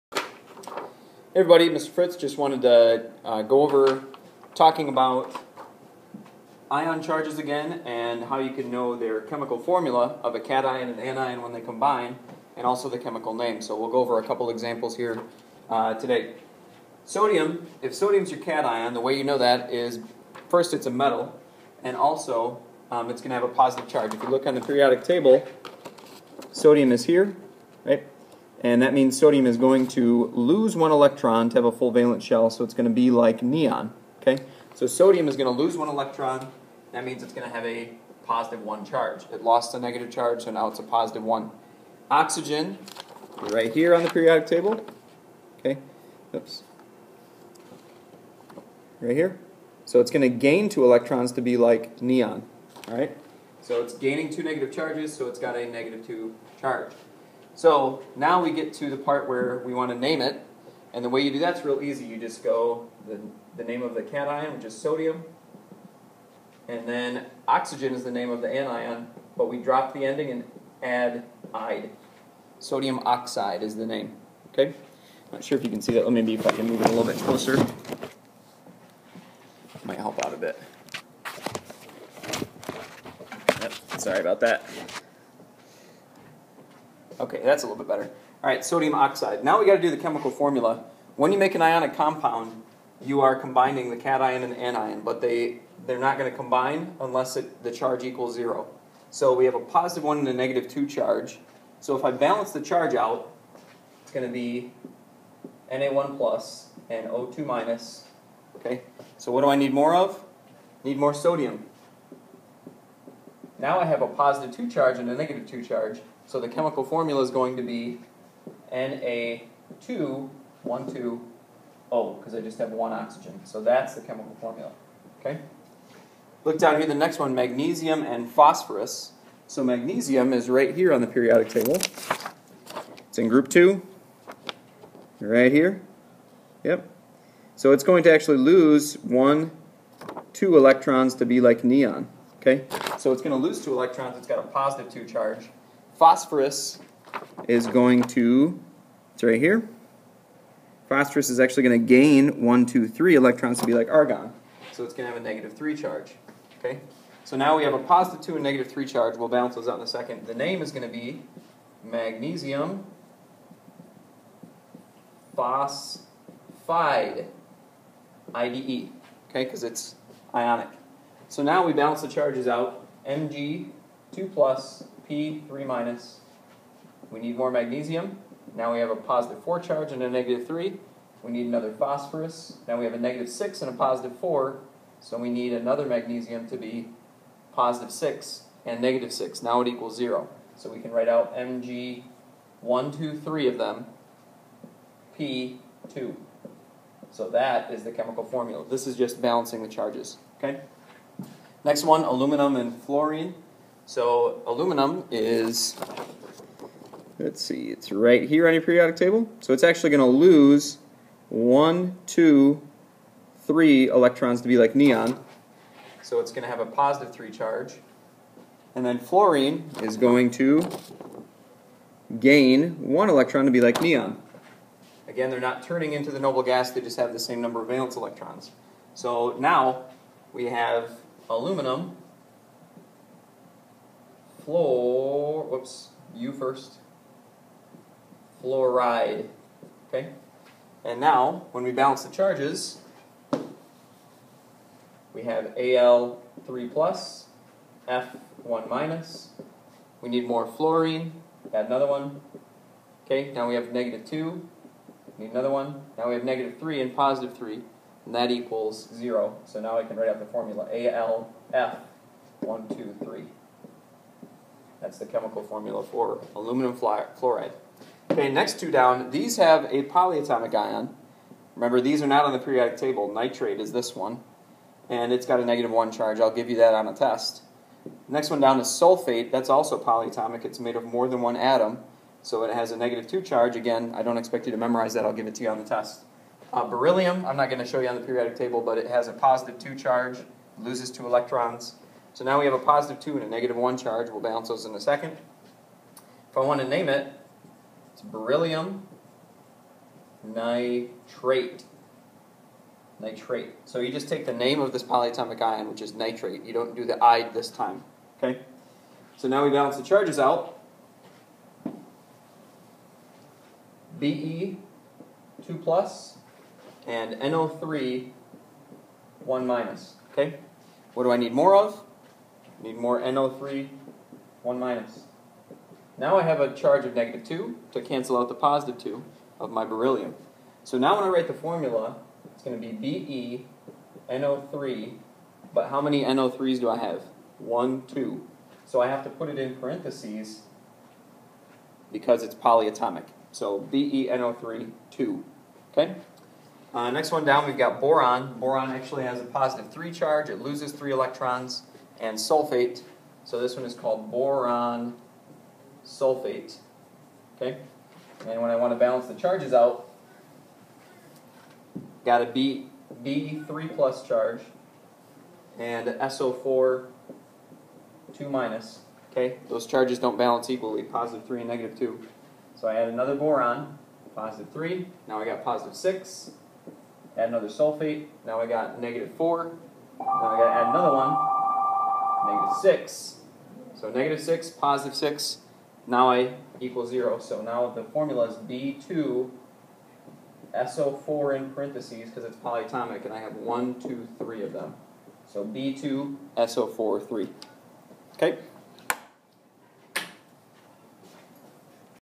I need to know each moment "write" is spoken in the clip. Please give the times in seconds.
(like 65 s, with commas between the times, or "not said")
190 s, 259 s, 331 s.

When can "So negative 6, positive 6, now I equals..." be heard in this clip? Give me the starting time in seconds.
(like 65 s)
383 s.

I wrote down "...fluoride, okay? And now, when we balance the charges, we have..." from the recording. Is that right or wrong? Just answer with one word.
right.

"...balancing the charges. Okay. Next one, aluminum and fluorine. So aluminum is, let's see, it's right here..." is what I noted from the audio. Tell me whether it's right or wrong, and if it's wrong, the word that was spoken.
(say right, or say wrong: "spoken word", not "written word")
right.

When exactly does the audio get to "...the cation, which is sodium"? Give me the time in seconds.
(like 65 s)
63 s.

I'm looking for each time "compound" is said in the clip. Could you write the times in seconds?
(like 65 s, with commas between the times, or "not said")
91 s.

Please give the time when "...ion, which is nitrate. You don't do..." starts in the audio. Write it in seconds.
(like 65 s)
305 s.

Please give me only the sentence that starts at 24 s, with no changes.
If you look on the periodic table, sodium is here, right?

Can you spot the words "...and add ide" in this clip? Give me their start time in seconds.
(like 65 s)
70 s.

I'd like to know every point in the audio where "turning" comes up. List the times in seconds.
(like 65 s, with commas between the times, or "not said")
225 s.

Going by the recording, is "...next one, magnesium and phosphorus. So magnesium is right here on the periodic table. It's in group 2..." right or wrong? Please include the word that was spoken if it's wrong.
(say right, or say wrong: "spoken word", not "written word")
right.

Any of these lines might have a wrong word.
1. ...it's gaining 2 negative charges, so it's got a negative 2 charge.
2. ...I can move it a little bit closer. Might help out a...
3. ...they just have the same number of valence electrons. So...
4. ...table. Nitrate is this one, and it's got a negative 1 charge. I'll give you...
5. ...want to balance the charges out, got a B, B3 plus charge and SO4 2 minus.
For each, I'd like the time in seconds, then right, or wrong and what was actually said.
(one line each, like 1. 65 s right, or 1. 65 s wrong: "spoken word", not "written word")
1. 53 s right
2. 76 s right
3. 226 s right
4. 272 s right
5. 358 s right.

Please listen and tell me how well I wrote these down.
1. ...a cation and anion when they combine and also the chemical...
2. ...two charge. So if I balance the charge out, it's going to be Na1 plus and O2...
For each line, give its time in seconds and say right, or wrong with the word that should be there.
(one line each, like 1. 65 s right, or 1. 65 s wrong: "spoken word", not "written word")
1. 10 s right
2. 100 s right.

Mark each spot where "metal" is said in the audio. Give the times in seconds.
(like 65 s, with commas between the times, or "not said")
20 s.